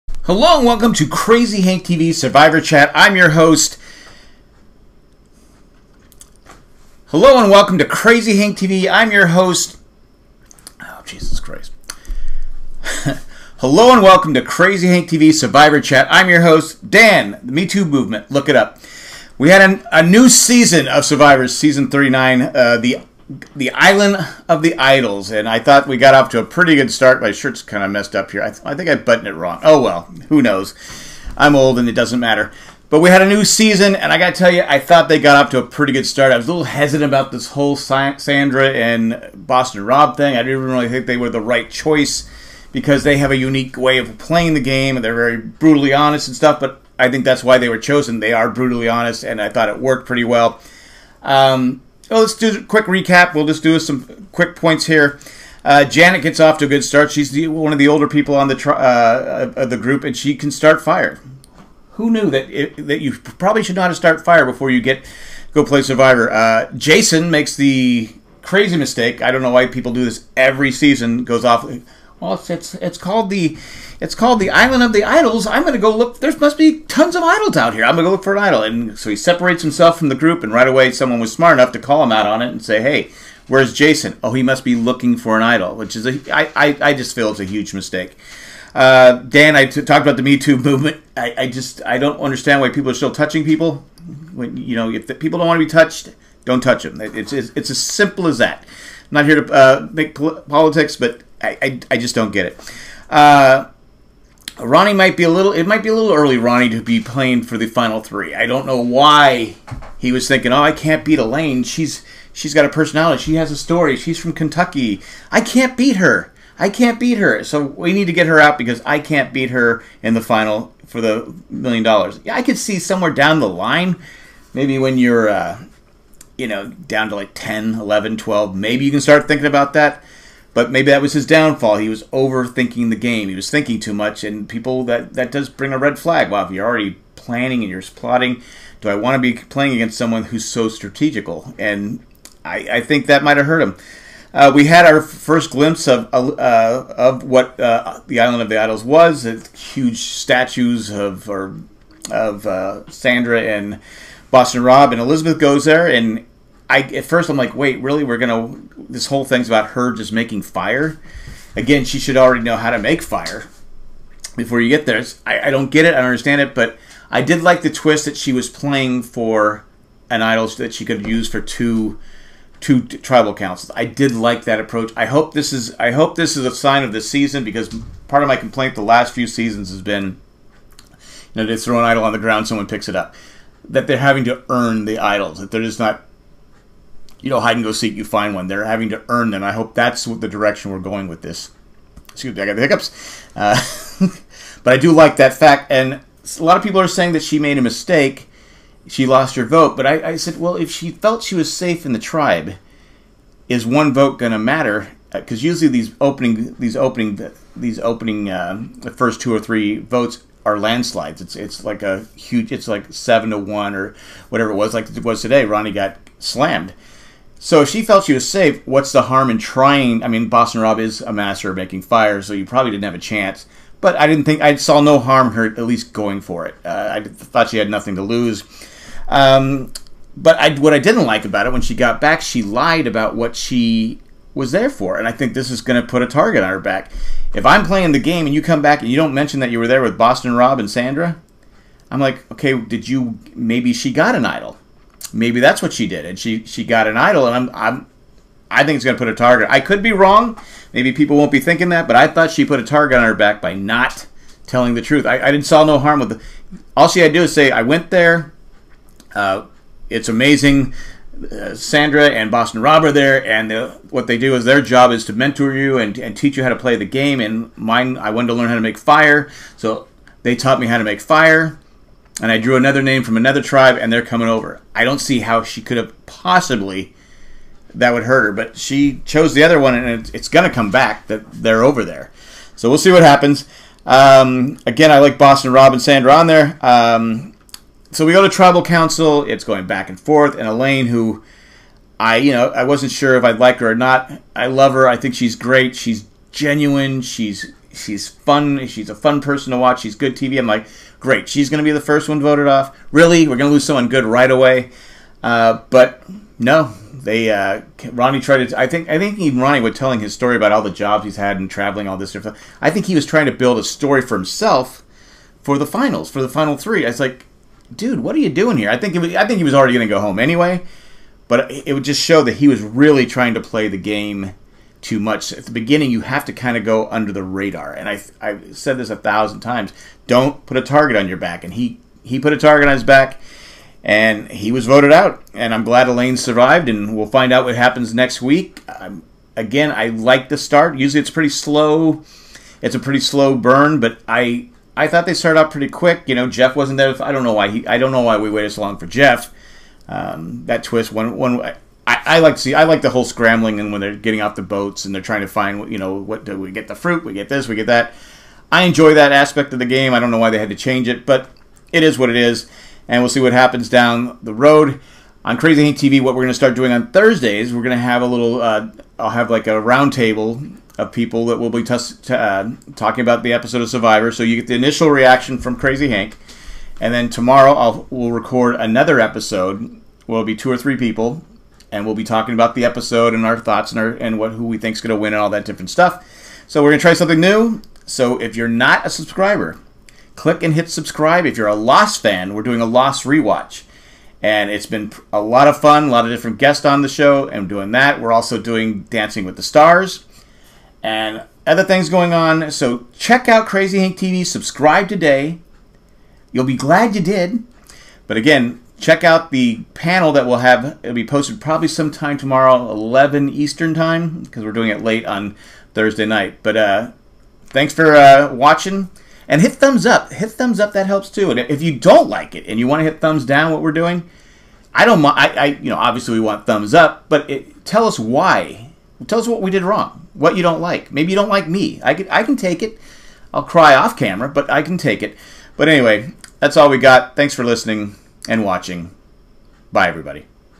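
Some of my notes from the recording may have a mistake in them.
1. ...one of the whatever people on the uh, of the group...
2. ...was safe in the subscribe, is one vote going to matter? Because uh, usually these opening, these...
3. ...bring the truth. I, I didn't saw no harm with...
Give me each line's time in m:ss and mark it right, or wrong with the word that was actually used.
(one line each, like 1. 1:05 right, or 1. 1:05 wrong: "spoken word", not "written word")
1. 0:57 wrong: "older", not "whatever"
2. 3:21 wrong: "tribe", not "subscribe"
3. 4:14 wrong: "telling", not "bring".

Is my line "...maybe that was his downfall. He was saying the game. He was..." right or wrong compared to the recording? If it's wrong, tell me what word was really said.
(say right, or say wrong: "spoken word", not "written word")
wrong: "overthinking", not "saying".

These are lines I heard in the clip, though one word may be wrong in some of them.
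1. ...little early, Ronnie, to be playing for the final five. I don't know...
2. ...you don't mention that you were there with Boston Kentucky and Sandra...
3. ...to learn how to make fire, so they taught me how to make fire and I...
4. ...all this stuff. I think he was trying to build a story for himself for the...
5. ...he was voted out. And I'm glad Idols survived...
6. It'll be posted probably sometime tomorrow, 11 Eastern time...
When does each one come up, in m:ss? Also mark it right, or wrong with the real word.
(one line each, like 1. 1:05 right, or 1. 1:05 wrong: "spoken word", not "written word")
1. 1:45 wrong: "three", not "five"
2. 3:58 wrong: "Rob", not "Kentucky"
3. 4:28 right
4. 5:11 right
5. 5:34 wrong: "Elaine", not "Idols"
6. 6:50 right.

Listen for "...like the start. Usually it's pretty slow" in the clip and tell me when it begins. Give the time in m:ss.
5:39.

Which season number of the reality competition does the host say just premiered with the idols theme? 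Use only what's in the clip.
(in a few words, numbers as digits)
39.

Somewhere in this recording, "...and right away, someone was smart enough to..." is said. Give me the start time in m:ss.
1:20.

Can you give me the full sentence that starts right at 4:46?
Um, so we go to tribal council.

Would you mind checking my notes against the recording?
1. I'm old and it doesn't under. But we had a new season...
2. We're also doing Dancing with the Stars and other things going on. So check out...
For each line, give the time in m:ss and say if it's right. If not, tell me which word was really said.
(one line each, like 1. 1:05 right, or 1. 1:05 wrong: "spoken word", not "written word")
1. 0:31 wrong: "matter", not "under"
2. 6:37 right.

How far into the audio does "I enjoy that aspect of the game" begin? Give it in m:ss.
5:58.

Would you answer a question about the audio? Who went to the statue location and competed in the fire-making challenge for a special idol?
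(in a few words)
Elizabeth.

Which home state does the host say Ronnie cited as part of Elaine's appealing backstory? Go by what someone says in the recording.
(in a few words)
Kentucky.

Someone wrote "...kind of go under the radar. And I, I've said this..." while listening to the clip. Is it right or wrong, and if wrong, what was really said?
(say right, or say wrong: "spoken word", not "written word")
right.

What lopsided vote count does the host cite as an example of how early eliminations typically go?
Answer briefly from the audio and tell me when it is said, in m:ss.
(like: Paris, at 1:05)
7 to 1, at 3:32.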